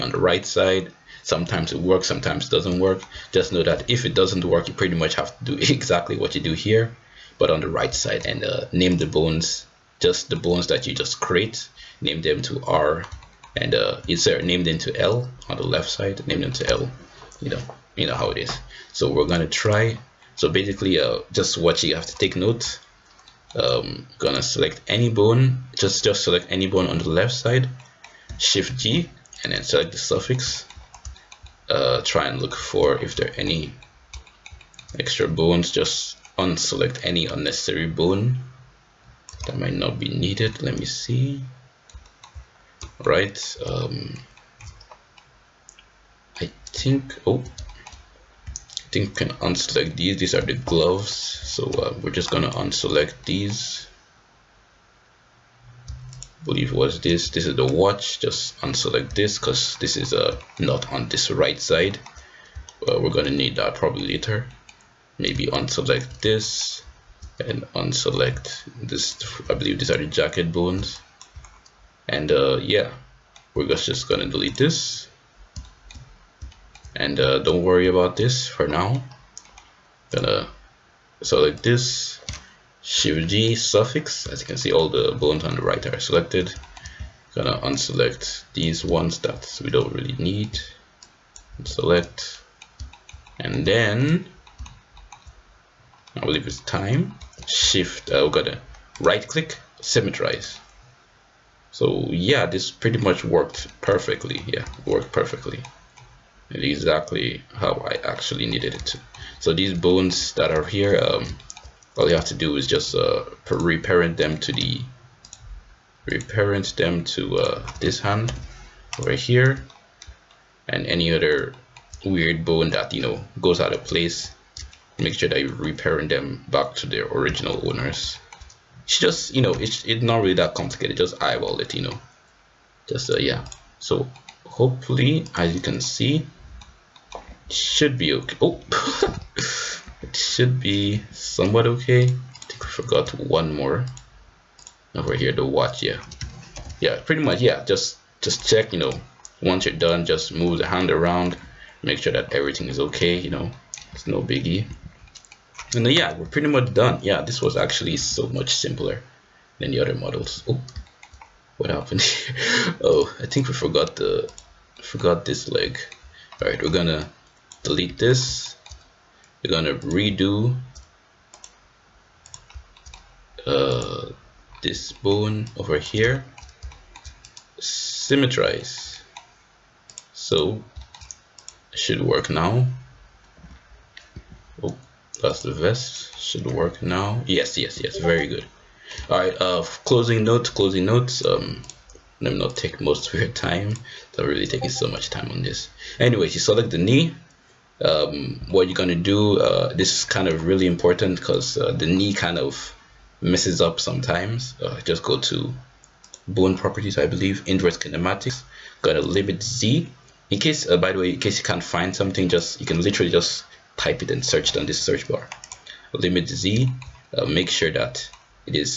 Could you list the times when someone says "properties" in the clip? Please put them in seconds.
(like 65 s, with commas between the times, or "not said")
206 s.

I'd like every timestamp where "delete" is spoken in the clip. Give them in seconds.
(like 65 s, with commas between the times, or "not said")
74 s, 167 s.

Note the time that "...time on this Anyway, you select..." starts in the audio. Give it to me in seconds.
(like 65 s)
195 s.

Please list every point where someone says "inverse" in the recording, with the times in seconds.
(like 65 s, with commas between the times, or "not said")
207 s.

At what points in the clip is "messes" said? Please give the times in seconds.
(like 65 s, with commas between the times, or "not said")
203 s.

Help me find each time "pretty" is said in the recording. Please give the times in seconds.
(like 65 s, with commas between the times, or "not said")
4 s, 102 s, 147 s, 156 s.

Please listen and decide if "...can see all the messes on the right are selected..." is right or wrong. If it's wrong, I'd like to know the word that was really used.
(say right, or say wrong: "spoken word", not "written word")
wrong: "bones", not "messes".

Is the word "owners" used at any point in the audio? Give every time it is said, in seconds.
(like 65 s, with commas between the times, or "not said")
127 s.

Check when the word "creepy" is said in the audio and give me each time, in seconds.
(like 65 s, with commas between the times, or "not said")
not said.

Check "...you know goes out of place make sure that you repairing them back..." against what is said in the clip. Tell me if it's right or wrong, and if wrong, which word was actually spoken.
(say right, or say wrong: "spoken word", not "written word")
right.